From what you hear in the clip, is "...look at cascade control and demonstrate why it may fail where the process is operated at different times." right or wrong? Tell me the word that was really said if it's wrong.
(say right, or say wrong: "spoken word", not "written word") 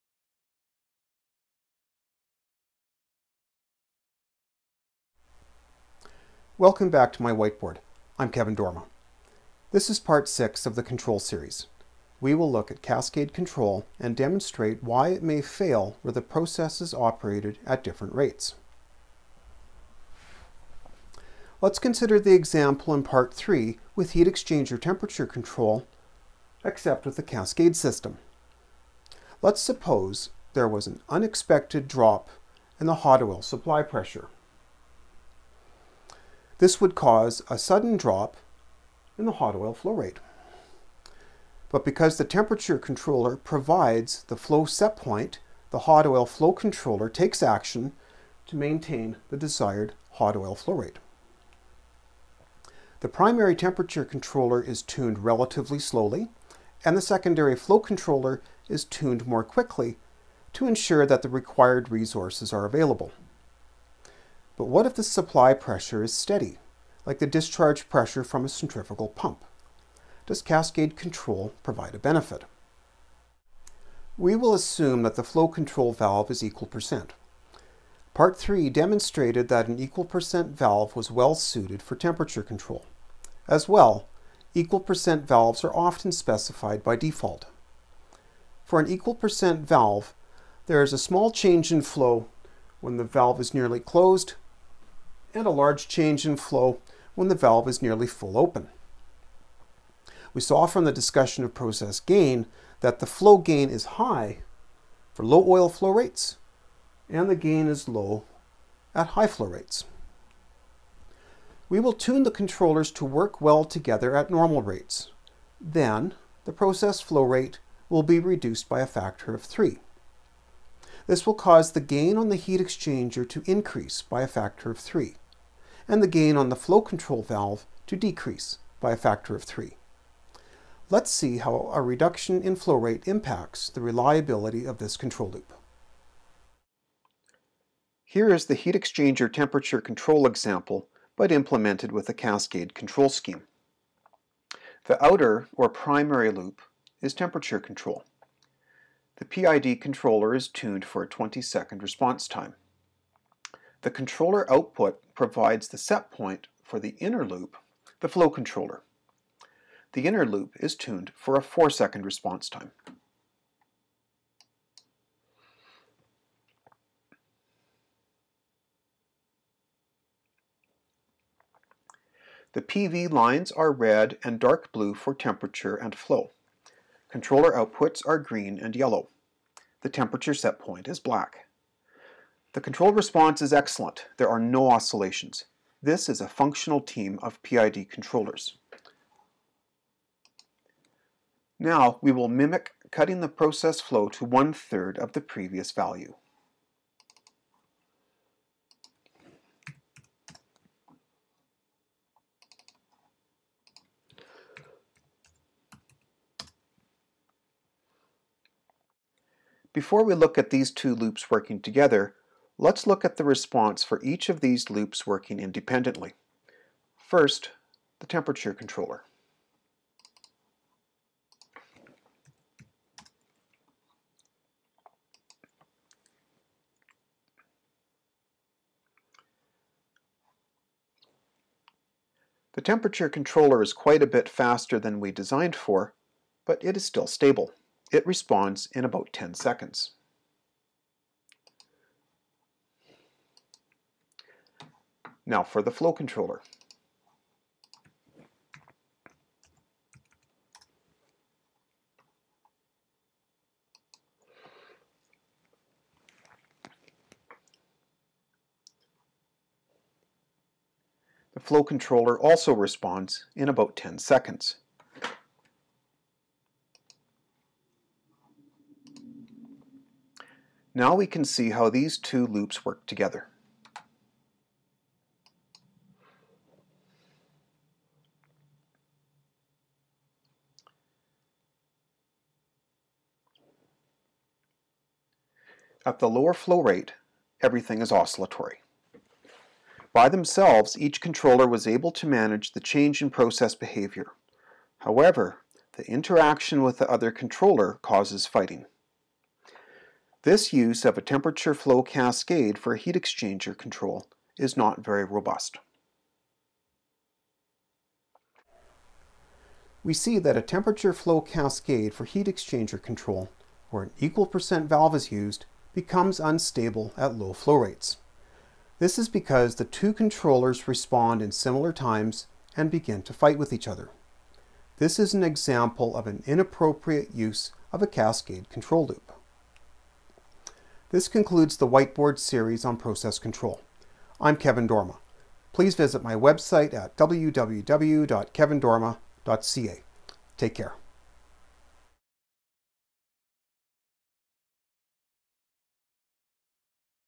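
wrong: "rates", not "times".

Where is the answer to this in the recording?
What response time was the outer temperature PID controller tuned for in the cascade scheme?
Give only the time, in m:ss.
2:31.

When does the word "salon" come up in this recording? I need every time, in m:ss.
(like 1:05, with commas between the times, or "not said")
not said.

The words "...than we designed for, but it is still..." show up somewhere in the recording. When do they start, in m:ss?
3:54.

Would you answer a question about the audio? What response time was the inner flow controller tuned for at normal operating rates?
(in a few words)
4 seconds.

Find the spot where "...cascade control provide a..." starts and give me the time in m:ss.
1:10.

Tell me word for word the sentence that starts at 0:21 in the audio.
Let's consider the example in part three with heat exchanger temperature control, except with the cascade system.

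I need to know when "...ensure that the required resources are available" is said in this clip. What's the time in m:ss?
1:00.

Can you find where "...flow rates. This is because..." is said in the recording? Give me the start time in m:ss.
5:17.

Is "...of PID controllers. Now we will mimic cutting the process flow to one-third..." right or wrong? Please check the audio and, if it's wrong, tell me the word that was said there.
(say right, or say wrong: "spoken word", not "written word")
right.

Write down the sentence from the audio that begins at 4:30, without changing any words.
Now we can see how these two loops work together.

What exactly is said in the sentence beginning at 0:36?
This would cause a sudden drop in the hot oil flow rate.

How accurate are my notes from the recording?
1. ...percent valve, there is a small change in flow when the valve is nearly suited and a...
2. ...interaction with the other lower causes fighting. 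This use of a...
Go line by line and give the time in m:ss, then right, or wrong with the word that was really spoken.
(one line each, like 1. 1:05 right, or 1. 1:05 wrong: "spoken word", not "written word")
1. 1:29 wrong: "closed", not "suited"
2. 4:55 wrong: "controller", not "lower".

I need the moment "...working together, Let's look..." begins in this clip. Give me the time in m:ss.
3:31.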